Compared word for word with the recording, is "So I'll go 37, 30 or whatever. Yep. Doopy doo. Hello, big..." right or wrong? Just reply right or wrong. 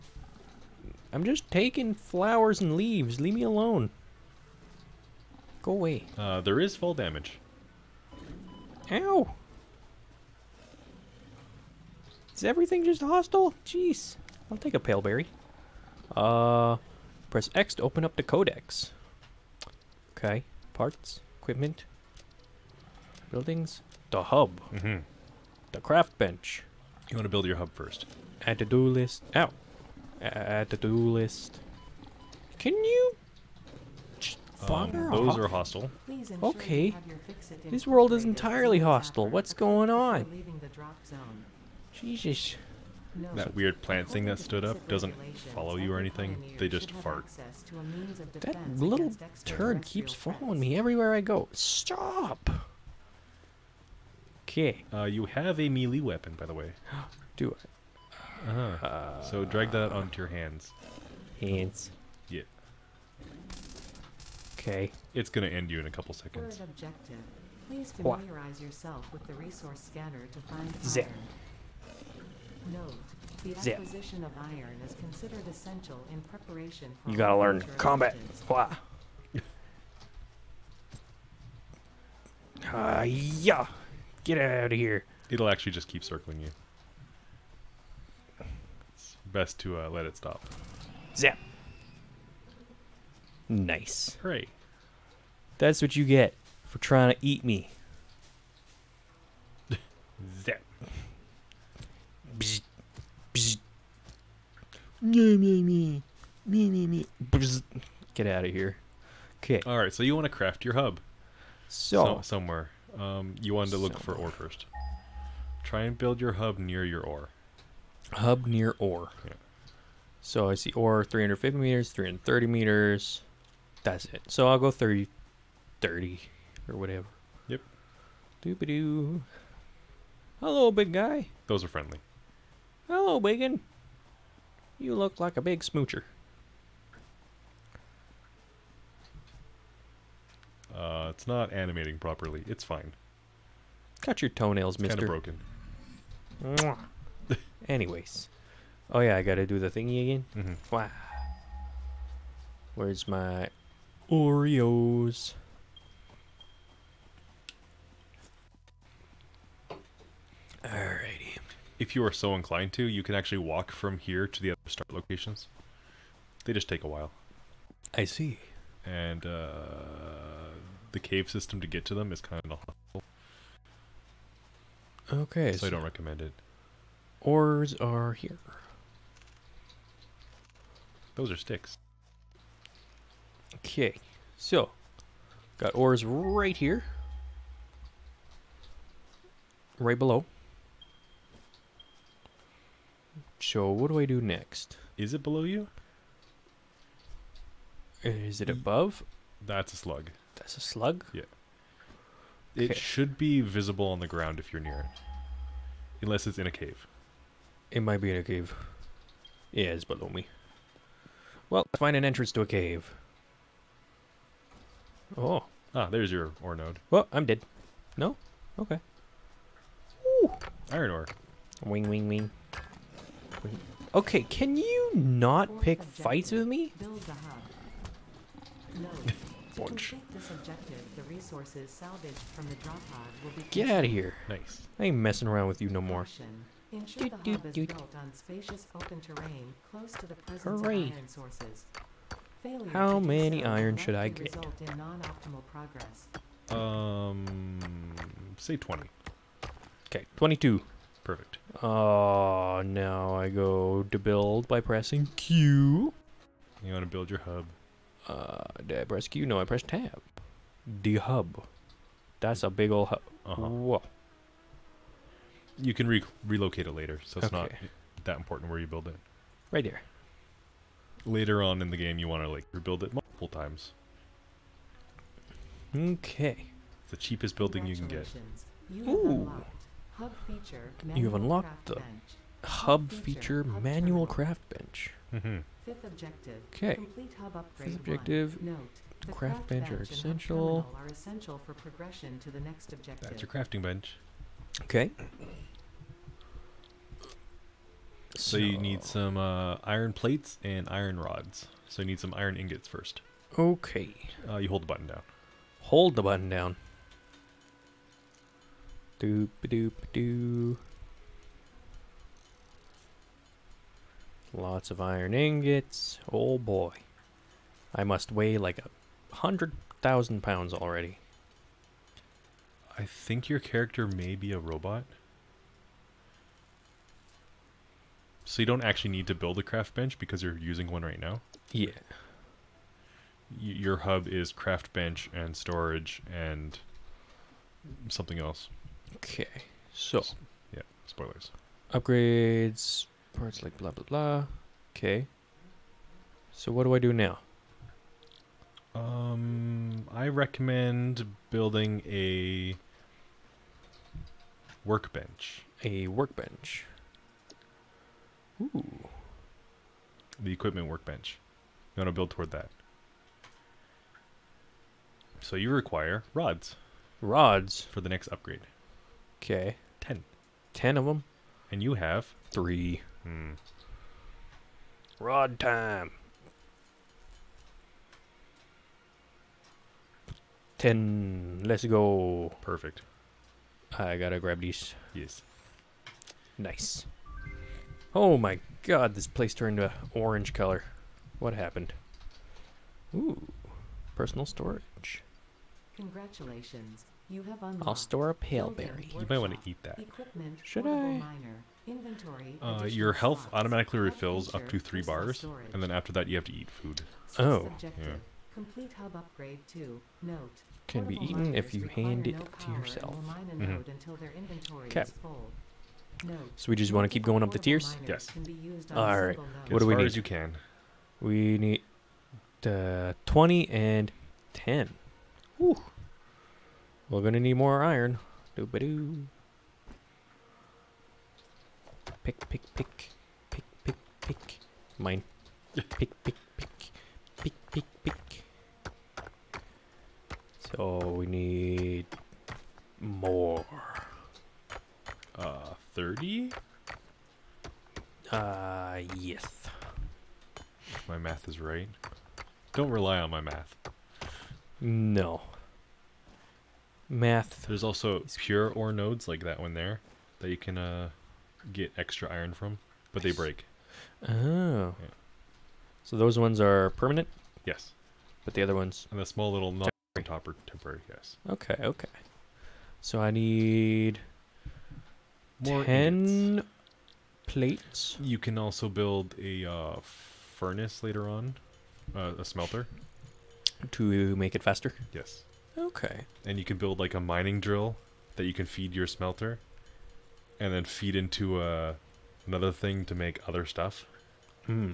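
wrong.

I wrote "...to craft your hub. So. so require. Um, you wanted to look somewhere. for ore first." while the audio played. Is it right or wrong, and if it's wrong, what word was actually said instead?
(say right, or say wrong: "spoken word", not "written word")
wrong: "somewhere", not "require".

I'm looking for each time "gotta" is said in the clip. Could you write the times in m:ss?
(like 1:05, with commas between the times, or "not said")
2:29, 6:23.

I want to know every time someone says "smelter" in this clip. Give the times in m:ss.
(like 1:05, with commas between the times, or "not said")
8:02, 8:08.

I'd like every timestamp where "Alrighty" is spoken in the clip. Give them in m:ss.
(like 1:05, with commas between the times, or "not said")
2:40.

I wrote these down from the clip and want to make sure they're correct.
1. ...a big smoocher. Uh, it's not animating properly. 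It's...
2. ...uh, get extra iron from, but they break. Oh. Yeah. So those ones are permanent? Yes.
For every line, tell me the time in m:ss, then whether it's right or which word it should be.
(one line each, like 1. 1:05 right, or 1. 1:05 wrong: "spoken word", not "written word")
1. 2:15 right
2. 7:40 right.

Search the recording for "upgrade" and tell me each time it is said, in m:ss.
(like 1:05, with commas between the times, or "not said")
5:41, 6:08, 6:48.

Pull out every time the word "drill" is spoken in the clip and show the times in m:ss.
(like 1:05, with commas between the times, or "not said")
8:07.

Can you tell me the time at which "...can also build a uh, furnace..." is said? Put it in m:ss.
7:58.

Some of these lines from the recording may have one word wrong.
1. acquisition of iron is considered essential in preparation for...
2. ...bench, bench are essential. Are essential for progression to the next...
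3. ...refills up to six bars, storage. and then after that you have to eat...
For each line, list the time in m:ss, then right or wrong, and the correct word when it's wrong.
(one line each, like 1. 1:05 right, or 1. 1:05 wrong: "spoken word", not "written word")
1. 1:13 right
2. 4:49 right
3. 6:43 wrong: "three", not "six".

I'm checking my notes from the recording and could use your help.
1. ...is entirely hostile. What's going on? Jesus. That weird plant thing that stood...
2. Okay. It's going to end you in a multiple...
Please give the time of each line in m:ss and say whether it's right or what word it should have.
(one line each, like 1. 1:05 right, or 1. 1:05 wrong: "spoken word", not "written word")
1. 0:38 right
2. 1:04 wrong: "couple", not "multiple".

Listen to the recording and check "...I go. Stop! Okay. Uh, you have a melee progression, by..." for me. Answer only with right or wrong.
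wrong.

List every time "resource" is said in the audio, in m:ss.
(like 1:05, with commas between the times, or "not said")
1:09, 3:51.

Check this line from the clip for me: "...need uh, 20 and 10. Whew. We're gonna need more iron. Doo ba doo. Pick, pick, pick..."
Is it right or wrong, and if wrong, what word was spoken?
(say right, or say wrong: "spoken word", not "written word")
right.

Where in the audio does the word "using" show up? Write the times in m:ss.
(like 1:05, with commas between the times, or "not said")
5:30.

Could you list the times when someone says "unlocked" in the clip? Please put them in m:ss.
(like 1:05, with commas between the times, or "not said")
4:41, 6:37.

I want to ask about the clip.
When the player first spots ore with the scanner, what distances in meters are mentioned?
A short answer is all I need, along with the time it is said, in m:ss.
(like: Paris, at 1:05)
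350 and 330 meters, at 2:01.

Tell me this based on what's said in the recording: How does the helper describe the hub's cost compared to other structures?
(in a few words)
the cheapest building.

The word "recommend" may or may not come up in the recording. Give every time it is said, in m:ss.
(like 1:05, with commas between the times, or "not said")
2:55, 5:50.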